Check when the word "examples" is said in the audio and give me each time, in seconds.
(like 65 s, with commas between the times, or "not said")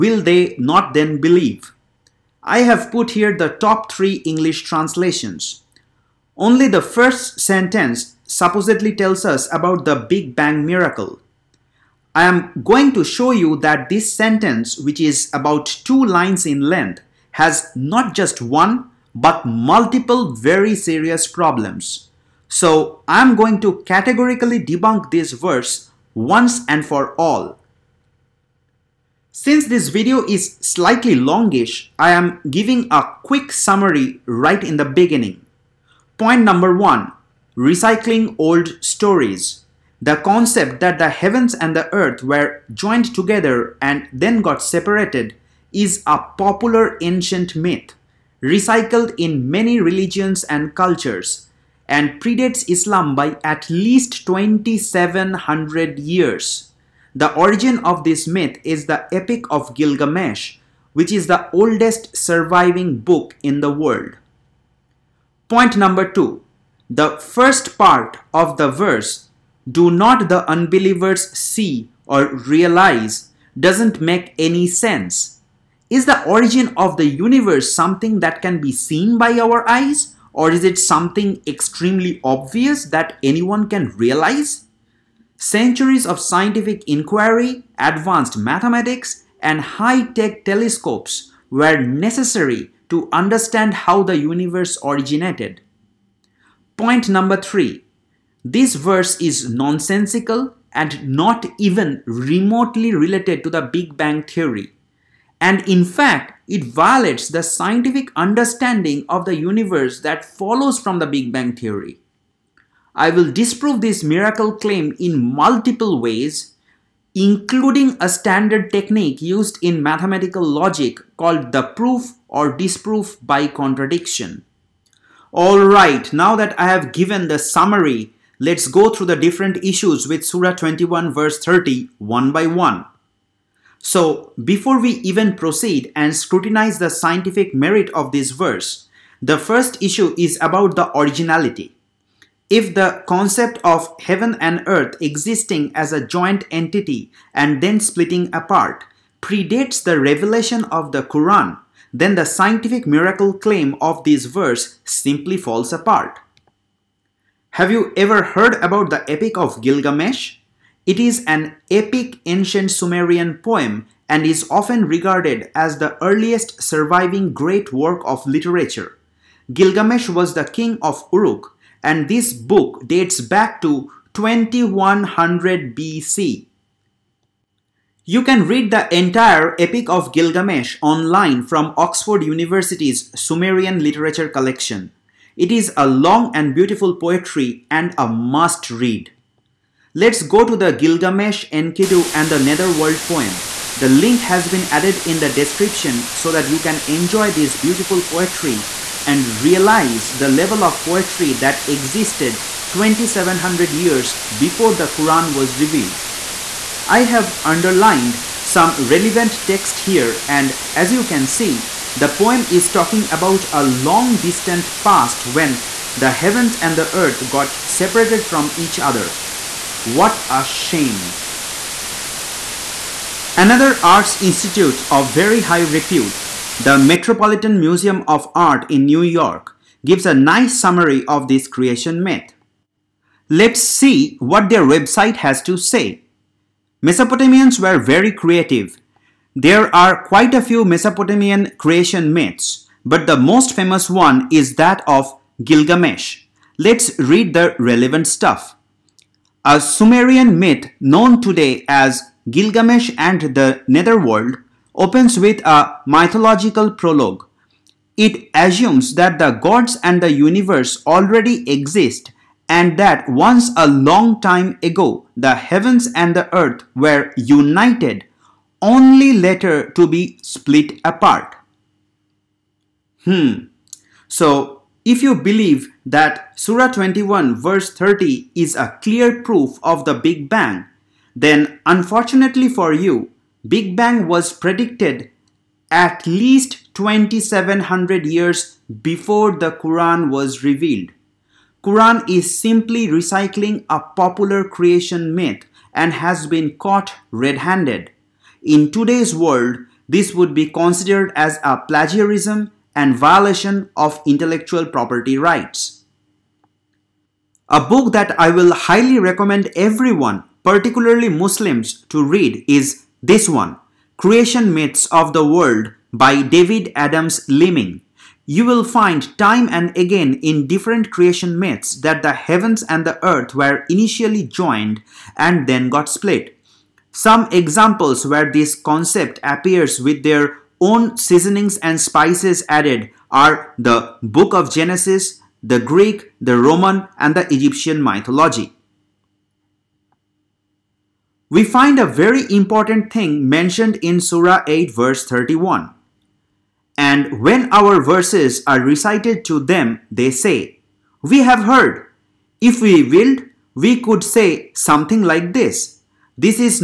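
327 s.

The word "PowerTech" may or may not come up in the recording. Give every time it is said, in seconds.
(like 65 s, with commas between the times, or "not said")
not said.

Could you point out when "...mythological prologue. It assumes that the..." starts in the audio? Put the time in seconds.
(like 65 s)
255 s.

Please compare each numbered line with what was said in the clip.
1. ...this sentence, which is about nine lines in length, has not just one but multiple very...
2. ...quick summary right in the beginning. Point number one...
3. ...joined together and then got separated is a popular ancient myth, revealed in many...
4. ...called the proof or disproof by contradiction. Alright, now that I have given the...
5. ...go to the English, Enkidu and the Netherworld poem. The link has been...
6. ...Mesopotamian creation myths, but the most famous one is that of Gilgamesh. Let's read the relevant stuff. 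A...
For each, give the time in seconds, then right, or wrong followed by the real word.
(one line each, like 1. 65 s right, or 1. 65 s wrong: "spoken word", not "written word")
1. 13 s wrong: "two", not "nine"
2. 33 s right
3. 42 s wrong: "recycled", not "revealed"
4. 121 s right
5. 190 s wrong: "Gilgamesh", not "English"
6. 240 s right.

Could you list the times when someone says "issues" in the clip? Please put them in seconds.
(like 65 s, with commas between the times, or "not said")
129 s, 139 s.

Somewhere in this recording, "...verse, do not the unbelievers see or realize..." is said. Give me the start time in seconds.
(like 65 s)
68 s.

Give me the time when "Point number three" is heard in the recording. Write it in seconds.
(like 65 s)
96 s.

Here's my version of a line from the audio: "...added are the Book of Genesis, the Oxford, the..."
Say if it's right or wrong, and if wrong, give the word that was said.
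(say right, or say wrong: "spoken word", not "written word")
wrong: "Greek", not "Oxford".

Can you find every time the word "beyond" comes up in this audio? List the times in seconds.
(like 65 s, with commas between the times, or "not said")
not said.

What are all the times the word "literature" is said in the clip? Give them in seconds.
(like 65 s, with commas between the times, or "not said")
168 s, 183 s.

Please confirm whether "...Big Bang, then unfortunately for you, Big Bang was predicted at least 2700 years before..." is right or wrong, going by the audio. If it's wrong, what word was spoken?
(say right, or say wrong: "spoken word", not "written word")
right.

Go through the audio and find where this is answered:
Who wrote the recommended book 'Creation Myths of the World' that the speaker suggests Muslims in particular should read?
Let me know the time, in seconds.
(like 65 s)
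316 s.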